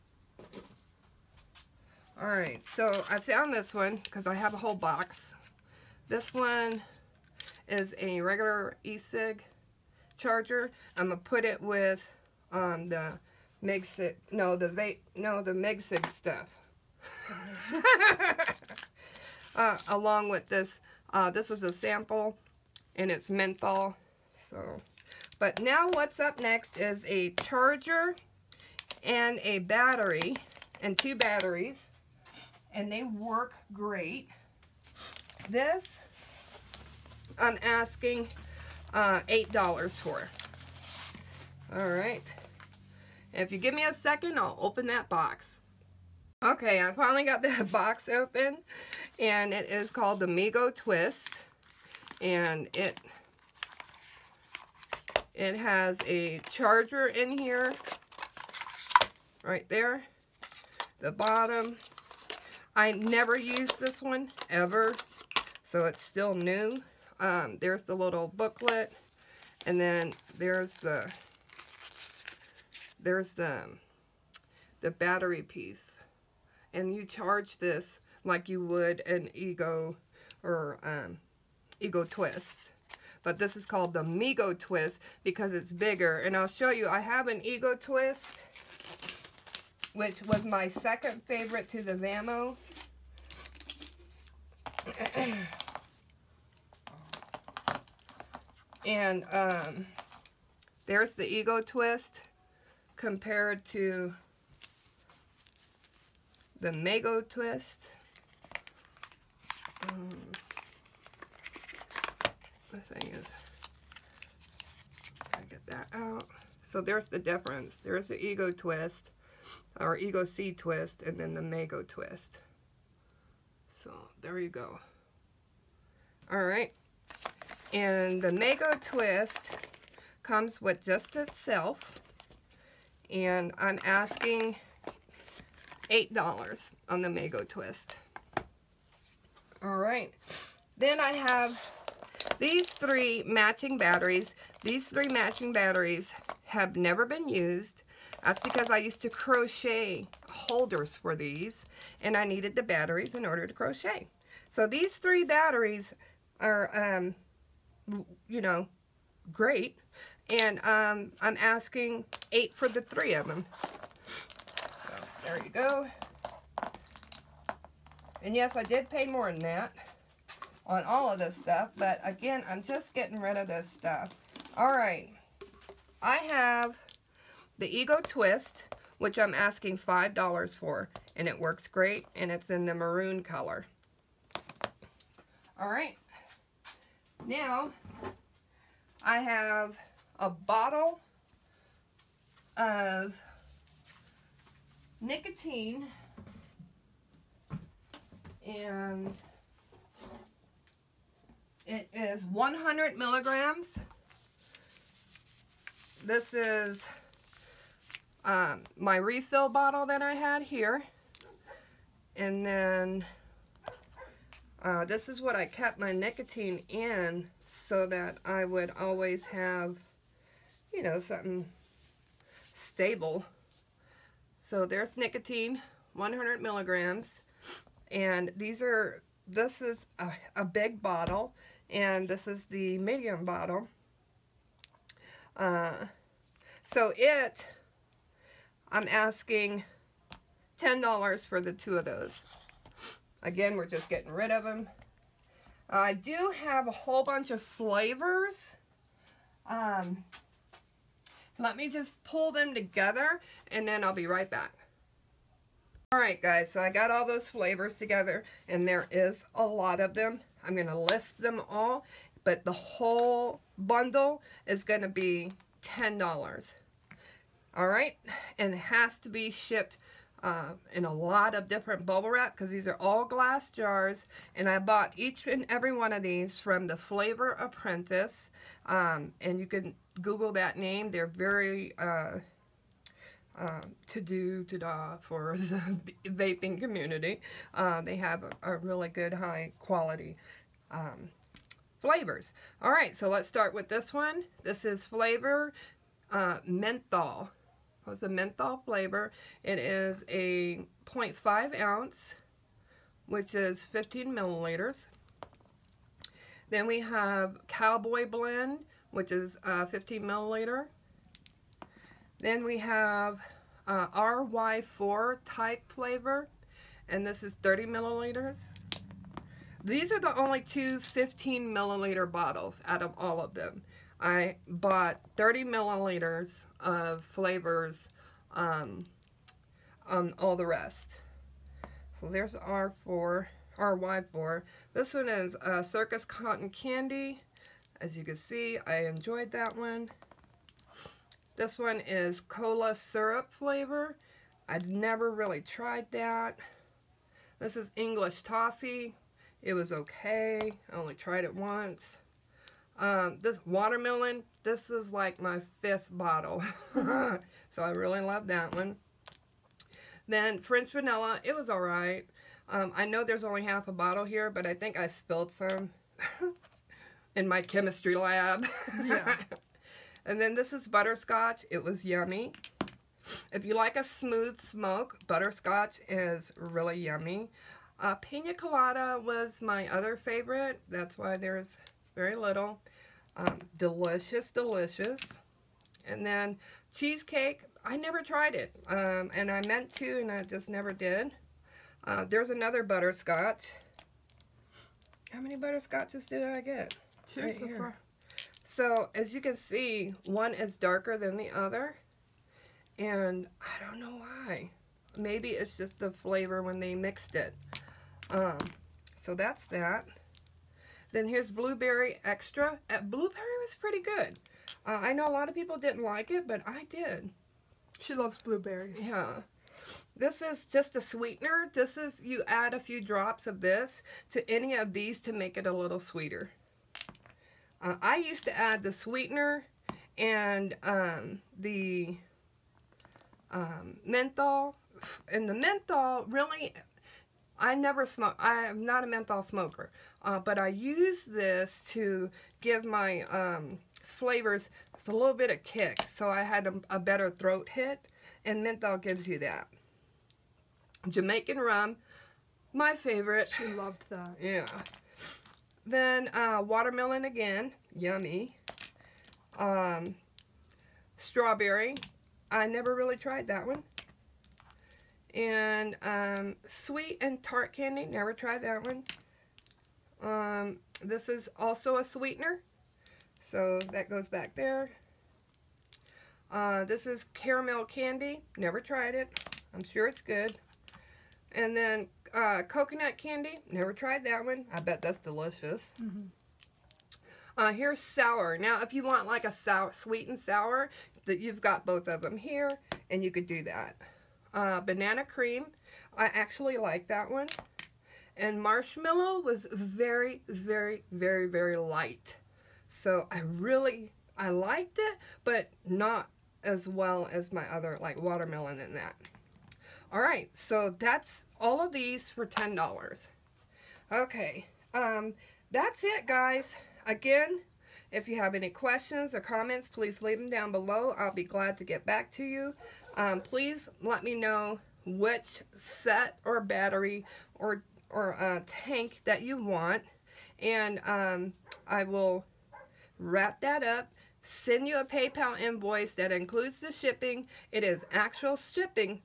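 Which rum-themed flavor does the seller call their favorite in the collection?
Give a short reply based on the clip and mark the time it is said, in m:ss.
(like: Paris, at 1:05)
Jamaican rum, at 7:30.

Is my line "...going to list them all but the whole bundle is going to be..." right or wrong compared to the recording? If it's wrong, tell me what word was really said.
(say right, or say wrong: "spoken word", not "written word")
right.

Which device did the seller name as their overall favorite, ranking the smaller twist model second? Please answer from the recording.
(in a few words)
Vamo.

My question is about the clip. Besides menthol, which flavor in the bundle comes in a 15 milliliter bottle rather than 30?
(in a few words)
Cowboy Blend.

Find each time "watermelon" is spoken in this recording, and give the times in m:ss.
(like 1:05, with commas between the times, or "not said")
5:53, 7:36, 8:28.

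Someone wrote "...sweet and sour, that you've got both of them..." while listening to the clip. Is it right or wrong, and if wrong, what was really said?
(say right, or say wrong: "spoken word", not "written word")
right.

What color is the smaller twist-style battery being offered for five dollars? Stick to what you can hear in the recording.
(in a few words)
maroon.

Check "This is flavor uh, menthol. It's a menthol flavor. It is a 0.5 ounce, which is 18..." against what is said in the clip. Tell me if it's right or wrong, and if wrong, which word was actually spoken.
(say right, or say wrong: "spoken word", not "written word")
wrong: "15", not "18".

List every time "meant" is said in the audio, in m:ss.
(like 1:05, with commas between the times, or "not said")
6:29.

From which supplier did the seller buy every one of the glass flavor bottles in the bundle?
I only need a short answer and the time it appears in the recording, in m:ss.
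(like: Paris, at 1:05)
Flavor Apprentice, at 4:36.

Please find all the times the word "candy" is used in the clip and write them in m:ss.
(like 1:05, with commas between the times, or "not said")
5:36, 7:47, 7:57, 8:02.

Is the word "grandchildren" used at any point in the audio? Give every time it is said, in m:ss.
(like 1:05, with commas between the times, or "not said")
not said.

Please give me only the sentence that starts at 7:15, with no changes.
And the menthol really I never smoke.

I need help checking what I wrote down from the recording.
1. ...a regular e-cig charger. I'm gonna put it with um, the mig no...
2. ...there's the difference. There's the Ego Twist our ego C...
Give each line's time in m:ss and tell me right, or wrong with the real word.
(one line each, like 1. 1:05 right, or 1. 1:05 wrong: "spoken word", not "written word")
1. 0:07 right
2. 1:56 right.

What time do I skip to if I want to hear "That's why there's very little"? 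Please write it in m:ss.
6:20.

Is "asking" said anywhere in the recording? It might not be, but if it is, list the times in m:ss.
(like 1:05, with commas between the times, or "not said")
0:37, 2:13, 2:41, 2:59, 3:58.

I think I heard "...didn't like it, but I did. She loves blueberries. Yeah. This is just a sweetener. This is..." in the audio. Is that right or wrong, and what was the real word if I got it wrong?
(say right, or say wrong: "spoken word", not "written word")
right.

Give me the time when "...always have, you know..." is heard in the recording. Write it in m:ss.
3:38.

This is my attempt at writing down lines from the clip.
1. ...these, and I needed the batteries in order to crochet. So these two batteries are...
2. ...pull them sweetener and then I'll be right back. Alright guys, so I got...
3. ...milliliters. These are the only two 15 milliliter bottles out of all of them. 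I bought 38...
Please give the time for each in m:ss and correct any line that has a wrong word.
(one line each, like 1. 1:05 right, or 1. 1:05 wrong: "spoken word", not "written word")
1. 2:31 wrong: "three", not "two"
2. 4:12 wrong: "together", not "sweetener"
3. 5:17 wrong: "30", not "38".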